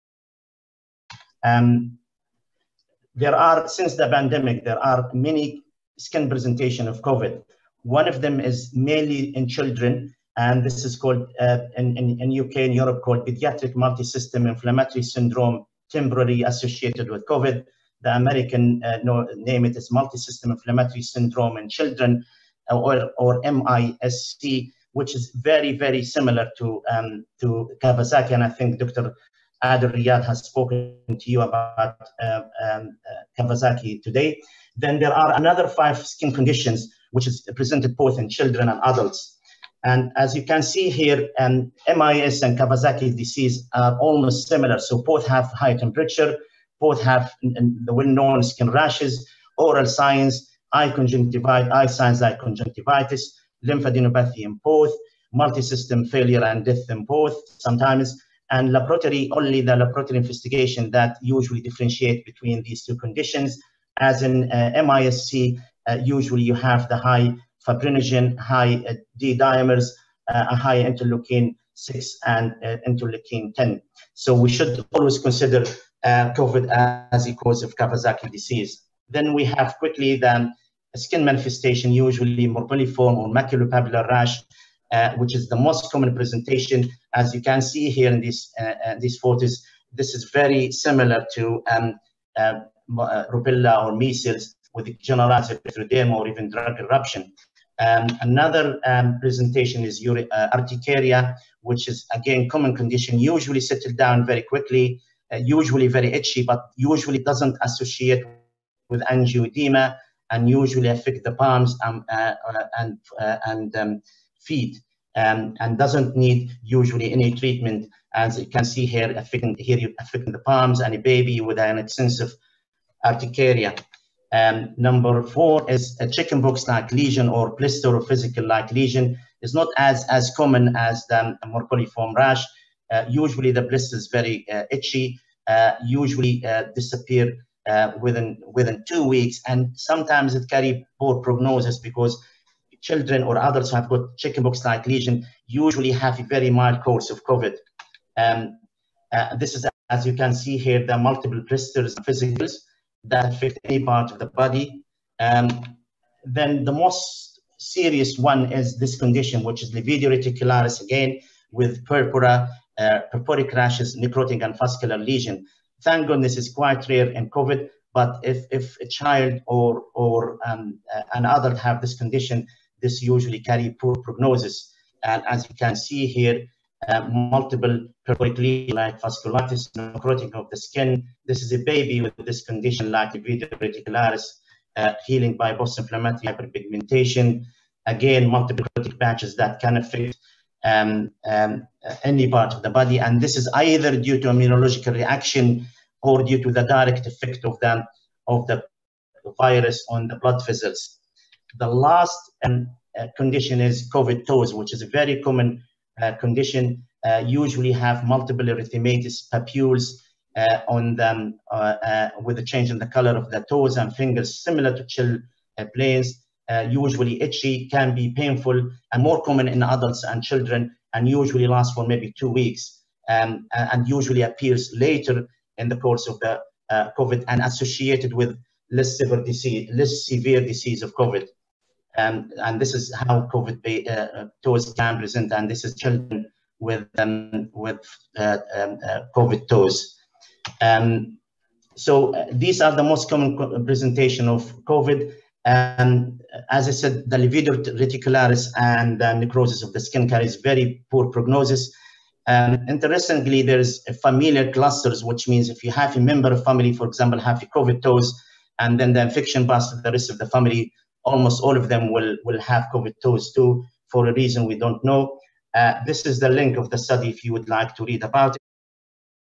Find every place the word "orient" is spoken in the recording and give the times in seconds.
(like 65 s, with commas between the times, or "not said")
not said.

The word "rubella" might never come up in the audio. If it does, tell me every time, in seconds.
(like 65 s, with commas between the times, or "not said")
93 s.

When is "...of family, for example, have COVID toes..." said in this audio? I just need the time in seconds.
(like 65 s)
256 s.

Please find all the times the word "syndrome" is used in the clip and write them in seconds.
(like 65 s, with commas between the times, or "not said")
15 s, 21 s.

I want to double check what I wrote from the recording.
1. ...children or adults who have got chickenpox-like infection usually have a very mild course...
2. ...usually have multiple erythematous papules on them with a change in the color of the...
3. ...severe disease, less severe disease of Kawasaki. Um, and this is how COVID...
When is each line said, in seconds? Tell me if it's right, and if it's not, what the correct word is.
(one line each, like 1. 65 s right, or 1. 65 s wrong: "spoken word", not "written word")
1. 142 s wrong: "lesion", not "infection"
2. 207 s right
3. 228 s wrong: "COVID", not "Kawasaki".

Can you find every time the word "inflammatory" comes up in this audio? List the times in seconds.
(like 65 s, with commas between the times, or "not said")
14 s, 20 s, 185 s.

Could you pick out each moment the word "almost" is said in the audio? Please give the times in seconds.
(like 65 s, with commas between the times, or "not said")
43 s, 261 s.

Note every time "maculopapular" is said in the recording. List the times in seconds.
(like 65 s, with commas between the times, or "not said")
82 s.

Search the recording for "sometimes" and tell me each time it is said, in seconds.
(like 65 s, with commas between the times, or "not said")
57 s, 139 s.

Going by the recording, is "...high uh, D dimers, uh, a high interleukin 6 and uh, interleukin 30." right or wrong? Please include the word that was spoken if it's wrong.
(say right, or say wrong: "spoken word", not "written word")
wrong: "10", not "30".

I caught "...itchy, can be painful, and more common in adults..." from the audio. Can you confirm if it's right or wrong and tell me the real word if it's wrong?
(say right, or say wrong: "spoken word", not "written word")
right.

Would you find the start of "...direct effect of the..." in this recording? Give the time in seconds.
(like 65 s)
196 s.